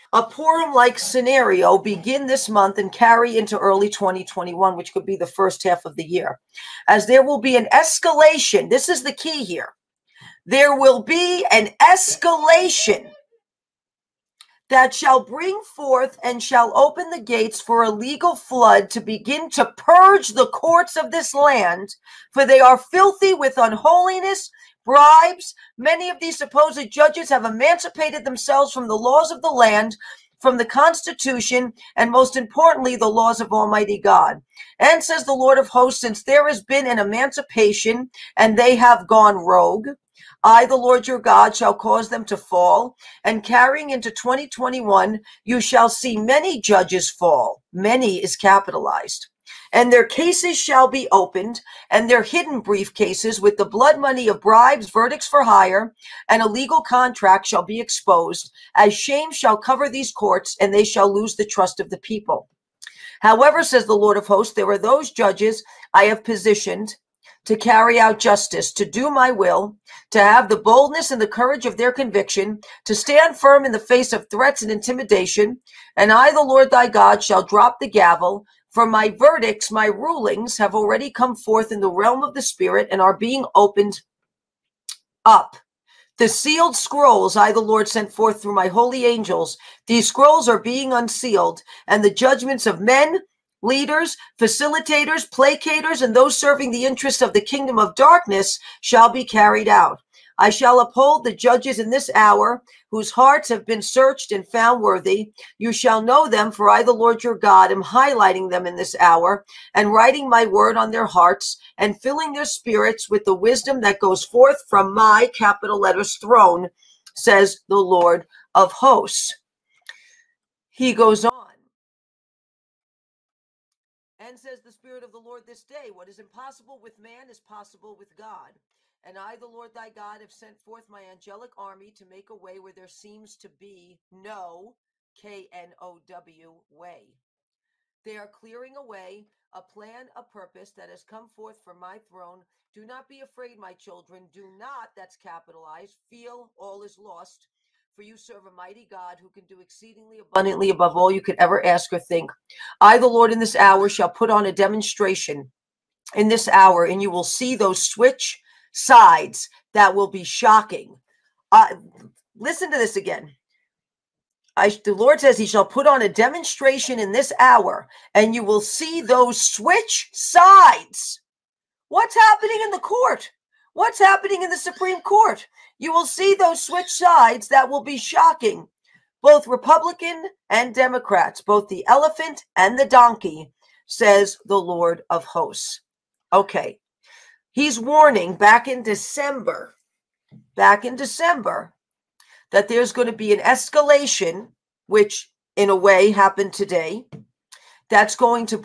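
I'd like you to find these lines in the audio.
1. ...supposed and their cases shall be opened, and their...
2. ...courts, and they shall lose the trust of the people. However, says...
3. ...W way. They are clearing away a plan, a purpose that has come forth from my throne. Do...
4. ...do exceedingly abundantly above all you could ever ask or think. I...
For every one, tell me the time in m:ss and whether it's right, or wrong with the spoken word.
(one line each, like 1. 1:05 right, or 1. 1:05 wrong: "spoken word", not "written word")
1. 0:48 wrong: "capitalized", not "supposed"
2. 1:00 right
3. 2:16 right
4. 2:29 right.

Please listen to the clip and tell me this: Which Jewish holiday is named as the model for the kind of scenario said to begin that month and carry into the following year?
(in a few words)
Purim.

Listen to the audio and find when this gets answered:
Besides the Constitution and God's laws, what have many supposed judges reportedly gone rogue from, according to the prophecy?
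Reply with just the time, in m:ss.
0:28.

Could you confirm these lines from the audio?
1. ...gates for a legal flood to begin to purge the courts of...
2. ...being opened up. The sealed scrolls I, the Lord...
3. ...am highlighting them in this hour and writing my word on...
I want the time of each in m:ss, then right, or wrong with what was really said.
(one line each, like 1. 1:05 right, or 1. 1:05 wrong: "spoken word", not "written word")
1. 0:17 right
2. 1:23 right
3. 1:47 right.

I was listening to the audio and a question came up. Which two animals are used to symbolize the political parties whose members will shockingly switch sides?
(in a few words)
The elephant and the donkey.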